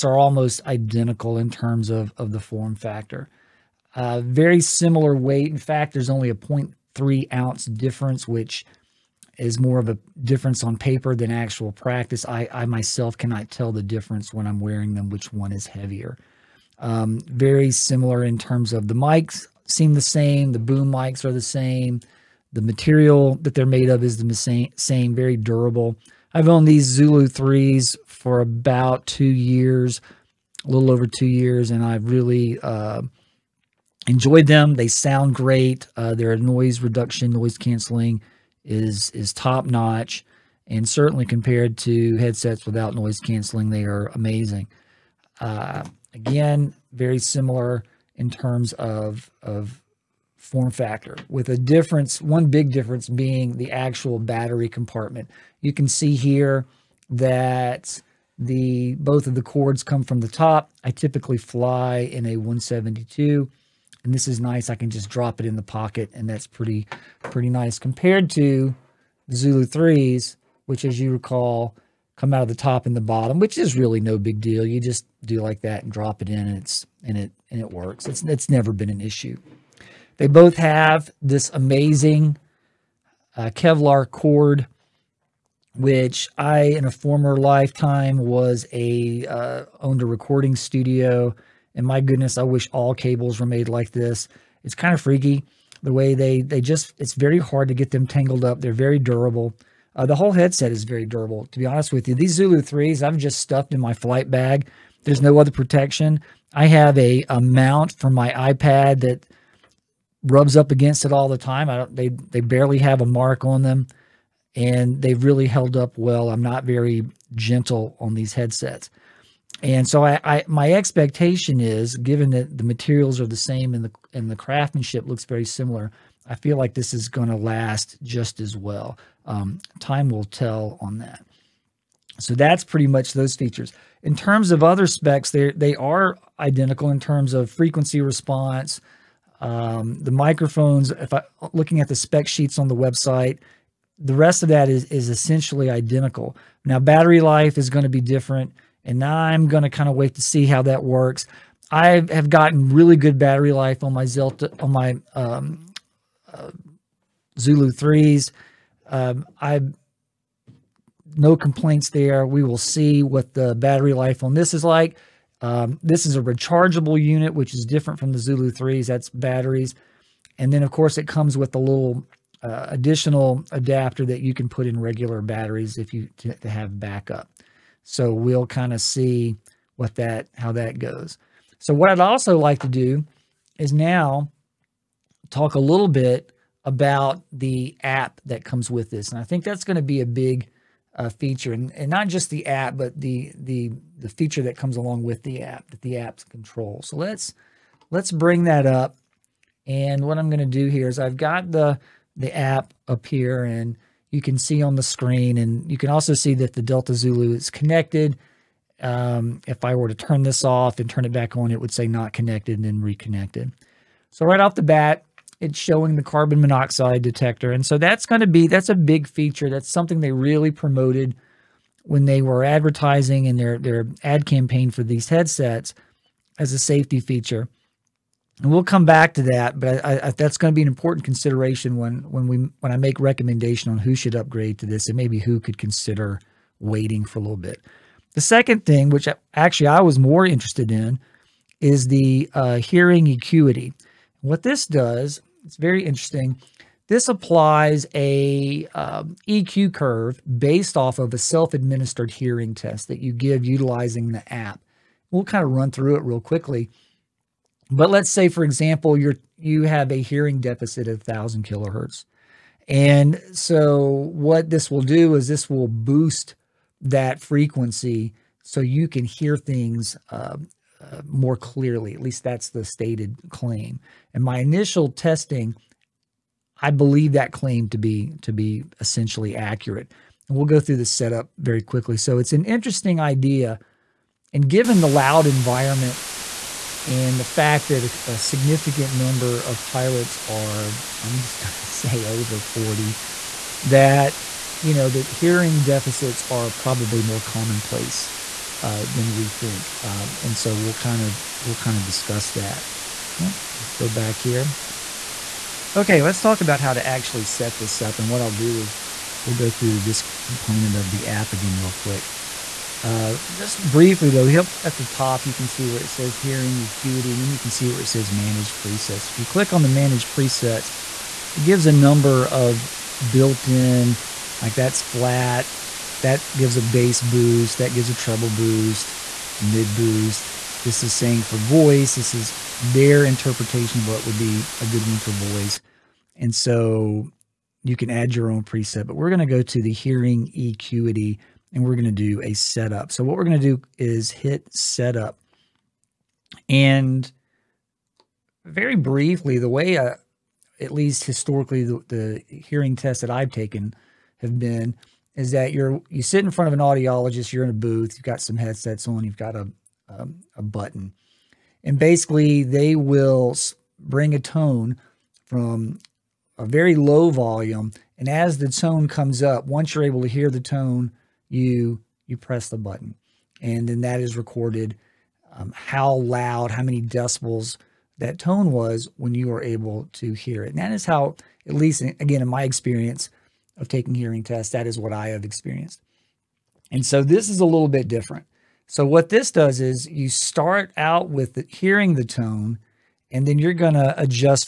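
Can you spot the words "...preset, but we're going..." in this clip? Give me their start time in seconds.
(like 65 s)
338 s.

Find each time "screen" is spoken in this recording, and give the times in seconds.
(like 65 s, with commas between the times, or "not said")
204 s.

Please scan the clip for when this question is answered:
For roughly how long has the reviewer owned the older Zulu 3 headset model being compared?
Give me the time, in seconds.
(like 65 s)
30 s.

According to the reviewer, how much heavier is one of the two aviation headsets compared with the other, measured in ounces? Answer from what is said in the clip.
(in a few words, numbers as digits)
0.3 ounce.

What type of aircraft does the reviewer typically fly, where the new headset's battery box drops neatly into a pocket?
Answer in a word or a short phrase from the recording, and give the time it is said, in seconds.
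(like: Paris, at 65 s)
172, at 62 s.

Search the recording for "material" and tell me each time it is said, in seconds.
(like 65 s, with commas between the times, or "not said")
22 s, 122 s.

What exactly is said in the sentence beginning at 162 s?
We will see what the battery life on this is like.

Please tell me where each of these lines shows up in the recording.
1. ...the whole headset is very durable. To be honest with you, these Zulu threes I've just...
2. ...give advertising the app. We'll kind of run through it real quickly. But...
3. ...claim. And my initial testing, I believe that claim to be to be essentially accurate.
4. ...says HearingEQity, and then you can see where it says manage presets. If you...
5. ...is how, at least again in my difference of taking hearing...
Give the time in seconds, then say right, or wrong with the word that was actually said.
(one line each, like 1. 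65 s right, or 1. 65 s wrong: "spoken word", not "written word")
1. 100 s right
2. 253 s wrong: "utilizing", not "advertising"
3. 273 s right
4. 315 s right
5. 380 s wrong: "experience", not "difference".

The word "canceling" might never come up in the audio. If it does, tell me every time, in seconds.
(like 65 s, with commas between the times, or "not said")
37 s, 43 s.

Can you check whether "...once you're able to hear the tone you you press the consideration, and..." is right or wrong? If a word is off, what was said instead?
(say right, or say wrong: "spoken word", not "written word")
wrong: "button", not "consideration".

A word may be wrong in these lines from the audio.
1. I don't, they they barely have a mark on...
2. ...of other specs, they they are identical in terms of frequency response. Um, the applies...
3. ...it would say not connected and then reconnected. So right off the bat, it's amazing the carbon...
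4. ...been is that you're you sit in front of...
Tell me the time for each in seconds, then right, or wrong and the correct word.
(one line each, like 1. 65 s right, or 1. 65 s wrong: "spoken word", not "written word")
1. 111 s right
2. 134 s wrong: "microphones", not "applies"
3. 211 s wrong: "showing", not "amazing"
4. 354 s right.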